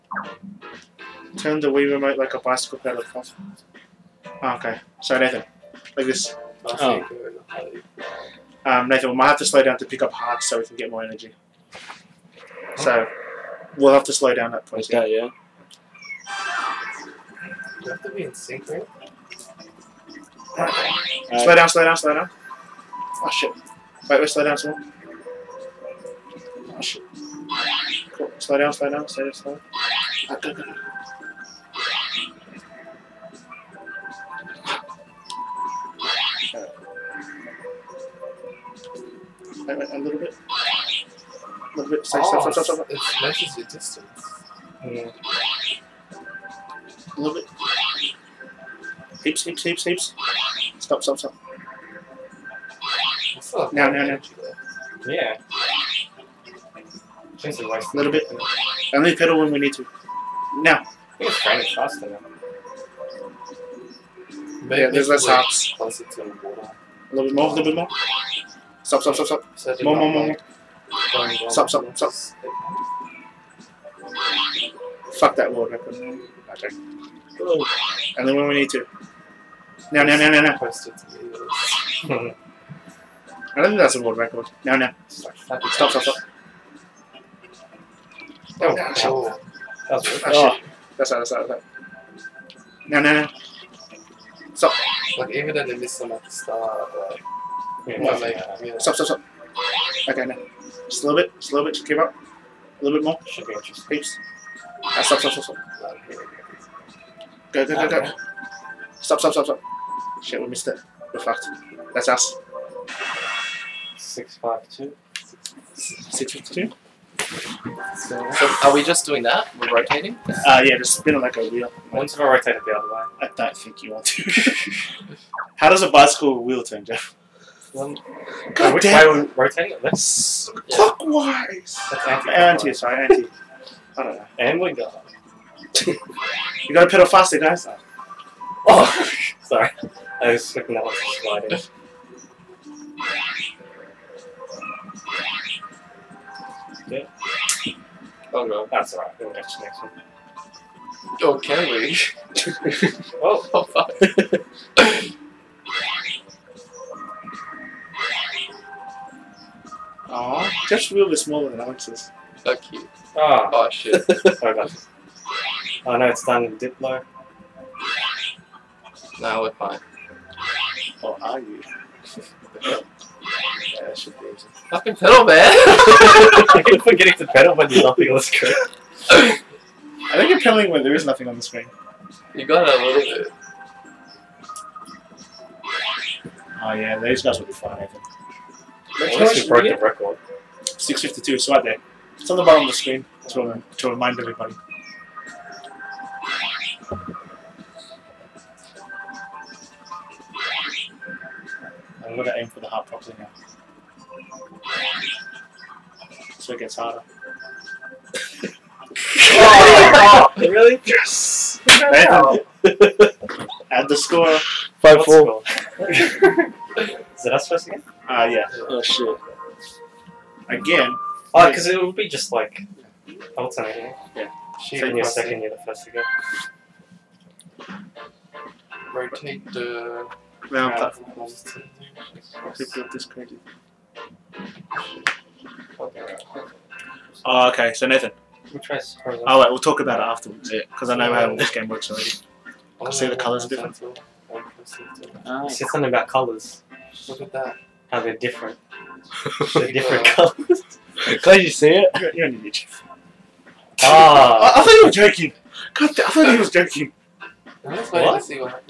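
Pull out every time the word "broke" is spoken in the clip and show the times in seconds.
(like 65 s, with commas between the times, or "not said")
189 s.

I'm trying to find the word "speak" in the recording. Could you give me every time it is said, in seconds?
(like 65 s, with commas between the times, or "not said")
not said.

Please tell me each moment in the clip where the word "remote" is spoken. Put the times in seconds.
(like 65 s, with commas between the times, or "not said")
1 s.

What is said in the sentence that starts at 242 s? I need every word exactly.
I oh, see the colours are different.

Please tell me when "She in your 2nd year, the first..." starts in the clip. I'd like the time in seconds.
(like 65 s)
224 s.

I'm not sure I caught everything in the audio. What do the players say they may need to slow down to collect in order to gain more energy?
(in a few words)
Hearts.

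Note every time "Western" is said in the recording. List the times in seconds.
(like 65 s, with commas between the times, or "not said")
not said.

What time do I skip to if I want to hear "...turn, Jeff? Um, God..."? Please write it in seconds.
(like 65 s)
126 s.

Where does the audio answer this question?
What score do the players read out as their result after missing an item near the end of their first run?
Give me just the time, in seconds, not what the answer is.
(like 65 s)
115 s.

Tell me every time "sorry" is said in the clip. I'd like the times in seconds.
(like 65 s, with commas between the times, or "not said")
132 s, 139 s, 164 s.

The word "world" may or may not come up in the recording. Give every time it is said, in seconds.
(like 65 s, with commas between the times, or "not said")
75 s, 84 s.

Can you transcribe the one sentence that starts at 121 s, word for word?
Once I rotate it the other way.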